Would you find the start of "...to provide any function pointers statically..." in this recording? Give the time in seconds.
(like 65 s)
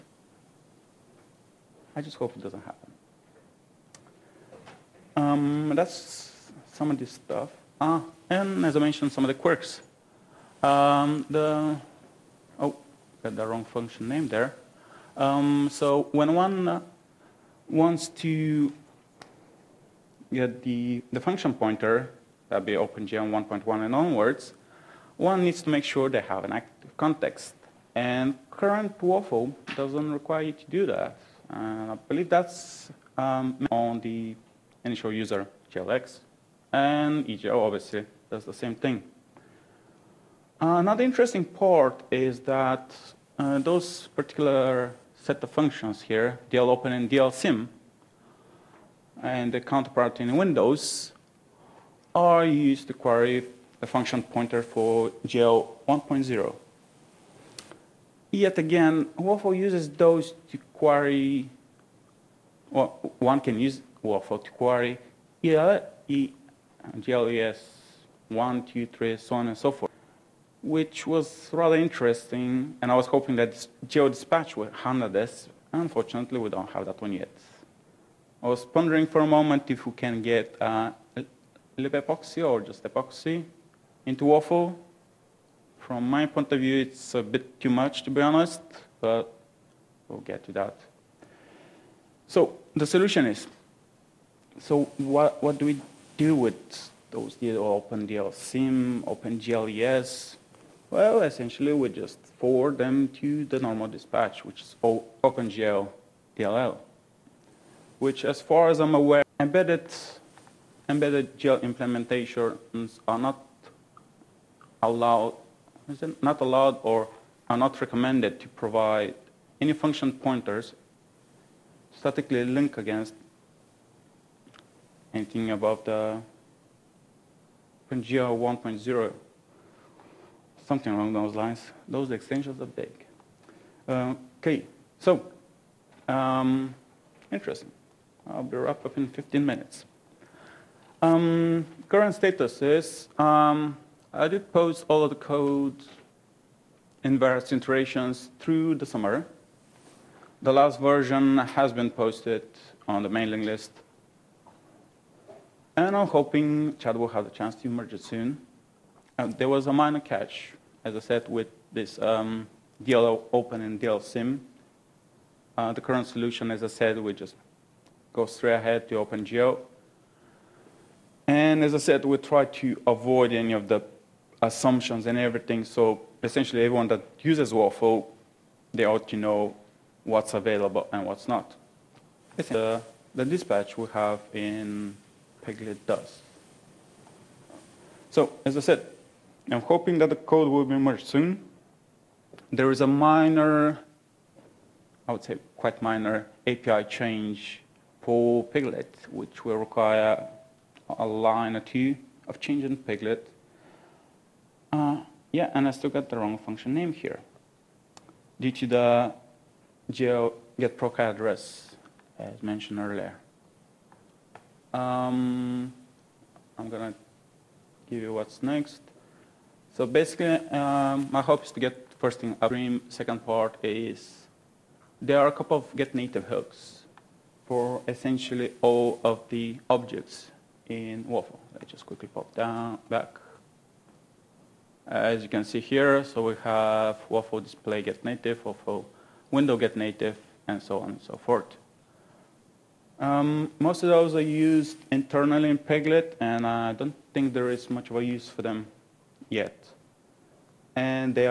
118 s.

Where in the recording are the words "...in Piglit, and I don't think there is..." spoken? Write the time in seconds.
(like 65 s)
245 s.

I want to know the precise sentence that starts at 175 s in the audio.
So essentially, everyone that uses Waffle, they ought to know what's available and what's not.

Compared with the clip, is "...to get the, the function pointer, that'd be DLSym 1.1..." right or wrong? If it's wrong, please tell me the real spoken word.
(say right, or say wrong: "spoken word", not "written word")
wrong: "OpenGL", not "DLSym".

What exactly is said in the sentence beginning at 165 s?
Uh, the current solution, as I said, we just go straight ahead to OpenGL.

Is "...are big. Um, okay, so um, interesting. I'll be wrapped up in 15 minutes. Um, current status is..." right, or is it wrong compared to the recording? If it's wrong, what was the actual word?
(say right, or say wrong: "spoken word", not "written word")
right.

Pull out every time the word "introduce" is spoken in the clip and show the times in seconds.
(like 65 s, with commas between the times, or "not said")
not said.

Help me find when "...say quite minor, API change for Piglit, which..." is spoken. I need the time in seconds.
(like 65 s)
195 s.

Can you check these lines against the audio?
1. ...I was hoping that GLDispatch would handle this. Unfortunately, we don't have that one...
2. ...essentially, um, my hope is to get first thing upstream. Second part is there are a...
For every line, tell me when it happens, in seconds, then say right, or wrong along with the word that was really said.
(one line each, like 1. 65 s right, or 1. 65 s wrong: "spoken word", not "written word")
1. 72 s right
2. 219 s wrong: "basically", not "essentially".